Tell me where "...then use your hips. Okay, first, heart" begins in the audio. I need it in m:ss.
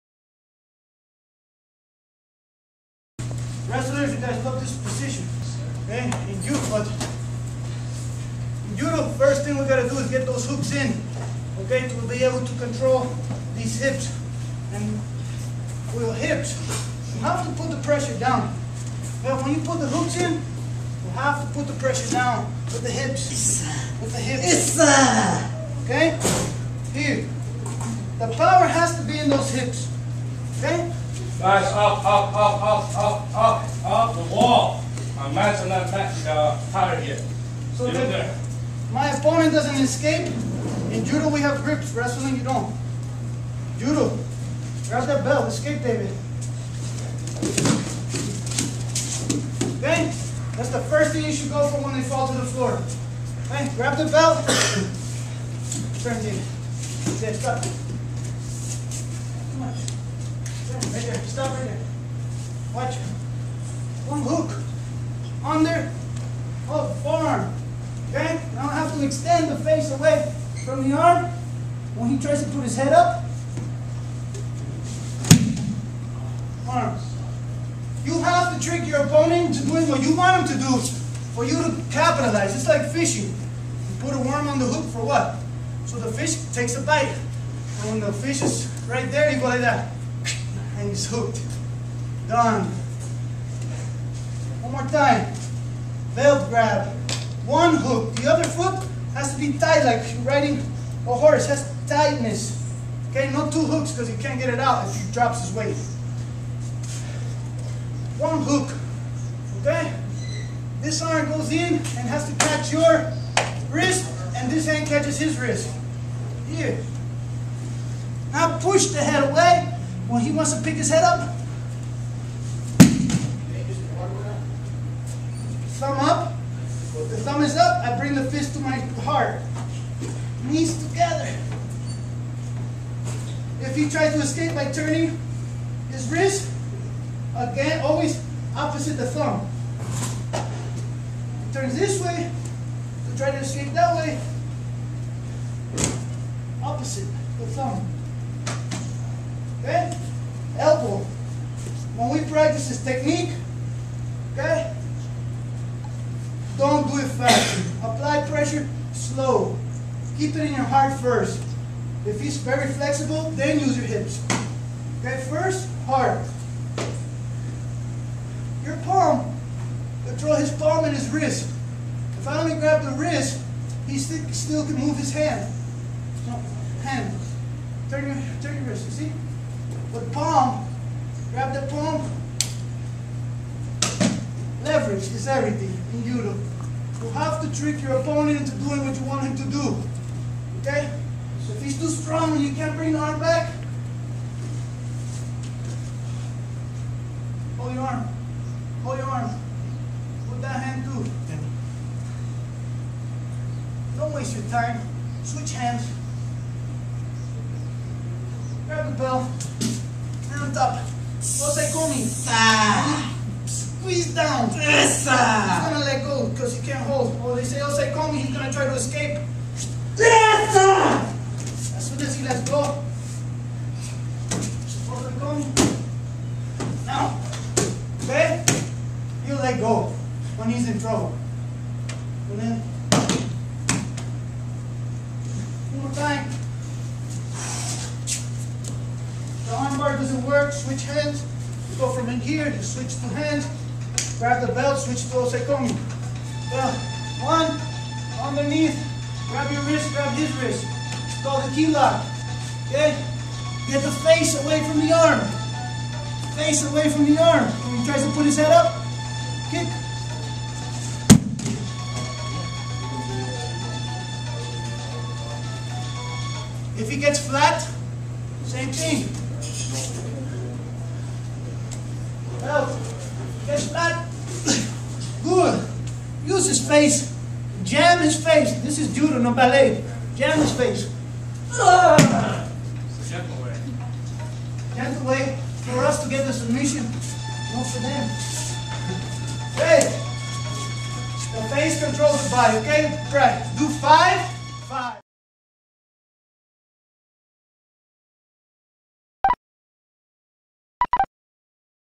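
2:43.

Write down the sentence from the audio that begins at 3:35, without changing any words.
He's gonna let go because he can't hold.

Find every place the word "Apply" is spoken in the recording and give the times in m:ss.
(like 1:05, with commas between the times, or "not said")
2:37.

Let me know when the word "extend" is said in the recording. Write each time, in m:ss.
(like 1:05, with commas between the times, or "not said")
1:09.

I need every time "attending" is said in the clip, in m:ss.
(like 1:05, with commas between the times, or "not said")
not said.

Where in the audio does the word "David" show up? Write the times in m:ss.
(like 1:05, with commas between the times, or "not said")
0:45, 0:56.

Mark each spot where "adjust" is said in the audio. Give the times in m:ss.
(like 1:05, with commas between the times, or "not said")
not said.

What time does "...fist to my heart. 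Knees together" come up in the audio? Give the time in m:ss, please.
2:08.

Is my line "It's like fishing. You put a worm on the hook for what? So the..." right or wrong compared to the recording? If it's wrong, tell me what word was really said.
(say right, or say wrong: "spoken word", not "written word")
right.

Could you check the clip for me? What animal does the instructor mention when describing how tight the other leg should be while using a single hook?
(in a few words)
A horse.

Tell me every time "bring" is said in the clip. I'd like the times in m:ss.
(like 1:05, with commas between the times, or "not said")
2:07, 3:12.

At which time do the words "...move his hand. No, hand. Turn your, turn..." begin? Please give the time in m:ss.
2:54.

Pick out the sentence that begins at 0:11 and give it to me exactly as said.
Okay, to be able to control these hips.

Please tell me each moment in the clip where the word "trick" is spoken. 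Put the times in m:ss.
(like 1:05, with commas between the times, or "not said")
1:18, 3:07.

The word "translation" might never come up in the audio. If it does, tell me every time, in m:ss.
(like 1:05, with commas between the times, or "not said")
not said.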